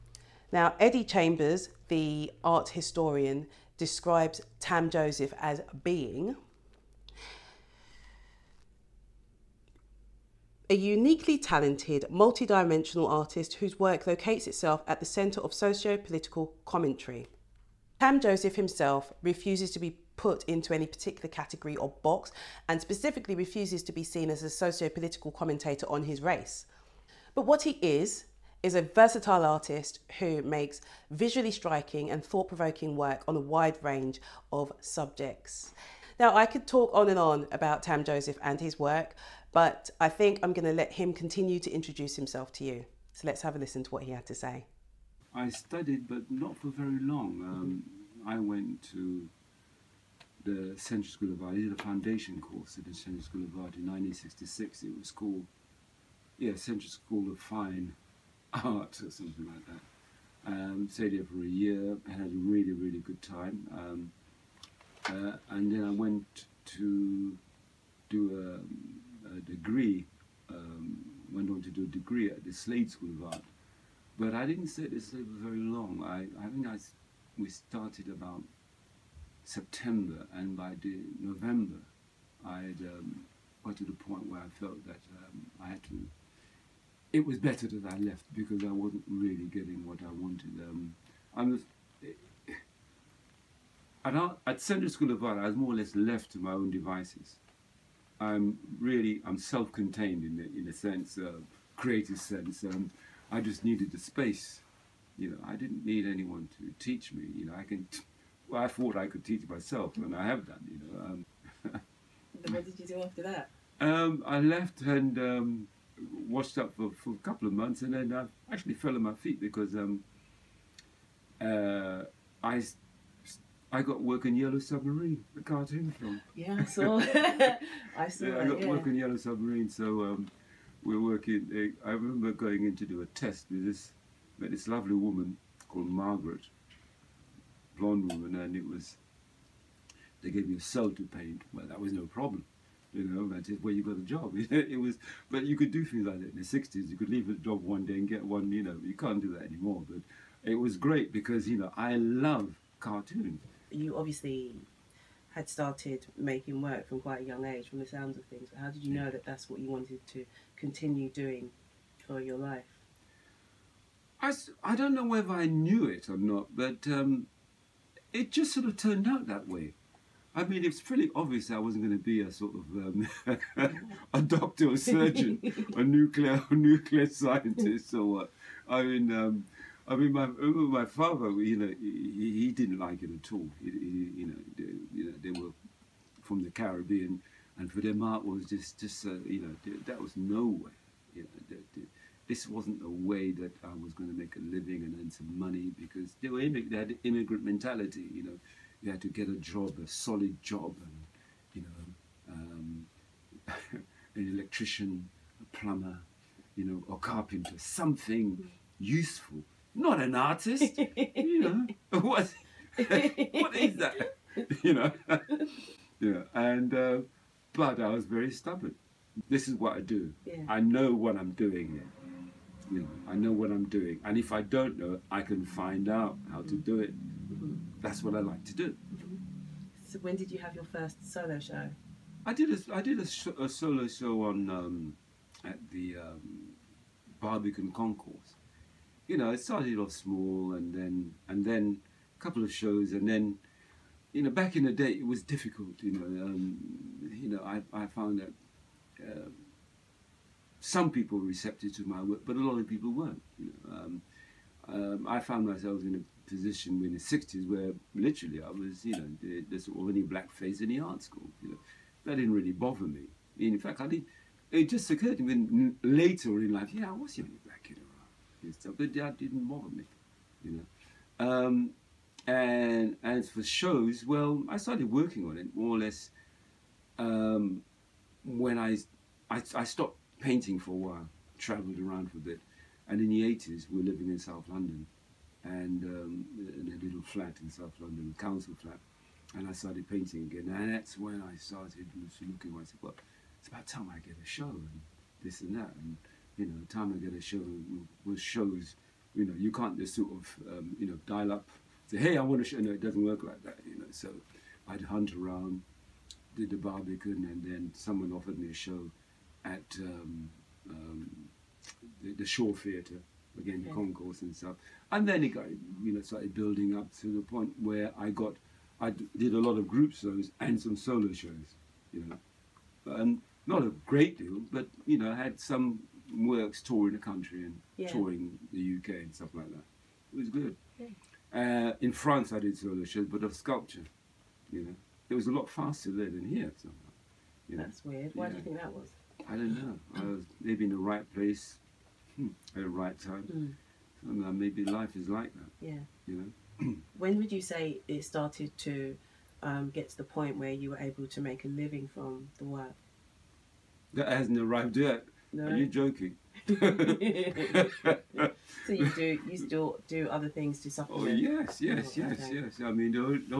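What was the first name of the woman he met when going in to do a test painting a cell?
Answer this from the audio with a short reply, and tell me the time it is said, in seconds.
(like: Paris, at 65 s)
Margaret, at 135 s.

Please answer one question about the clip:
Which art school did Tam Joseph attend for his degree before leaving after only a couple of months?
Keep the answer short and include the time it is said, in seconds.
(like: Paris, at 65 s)
Slade School of Art, at 72 s.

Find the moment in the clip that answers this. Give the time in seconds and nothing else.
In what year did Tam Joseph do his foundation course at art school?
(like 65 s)
53 s.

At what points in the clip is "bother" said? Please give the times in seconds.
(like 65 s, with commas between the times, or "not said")
262 s, 269 s.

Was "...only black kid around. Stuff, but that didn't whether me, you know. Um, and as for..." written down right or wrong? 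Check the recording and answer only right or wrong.
wrong.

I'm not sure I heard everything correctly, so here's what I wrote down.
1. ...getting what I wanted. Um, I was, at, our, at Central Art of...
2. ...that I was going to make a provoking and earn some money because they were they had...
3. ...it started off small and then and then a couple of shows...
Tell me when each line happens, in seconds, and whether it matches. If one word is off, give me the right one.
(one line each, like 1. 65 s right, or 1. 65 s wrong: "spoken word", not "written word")
1. 89 s wrong: "School", not "Art"
2. 193 s wrong: "living", not "provoking"
3. 239 s right.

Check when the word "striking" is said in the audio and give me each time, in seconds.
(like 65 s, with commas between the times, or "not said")
31 s.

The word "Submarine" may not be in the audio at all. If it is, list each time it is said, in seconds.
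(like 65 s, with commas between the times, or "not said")
124 s, 129 s.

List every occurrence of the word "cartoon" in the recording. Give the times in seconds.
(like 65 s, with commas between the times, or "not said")
125 s, 152 s.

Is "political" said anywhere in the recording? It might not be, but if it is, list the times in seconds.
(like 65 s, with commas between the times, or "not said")
15 s, 24 s.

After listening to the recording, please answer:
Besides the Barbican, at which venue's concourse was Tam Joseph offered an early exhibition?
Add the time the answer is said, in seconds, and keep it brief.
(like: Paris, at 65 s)
Shaw Theatre, at 312 s.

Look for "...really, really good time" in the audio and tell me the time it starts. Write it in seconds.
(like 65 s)
62 s.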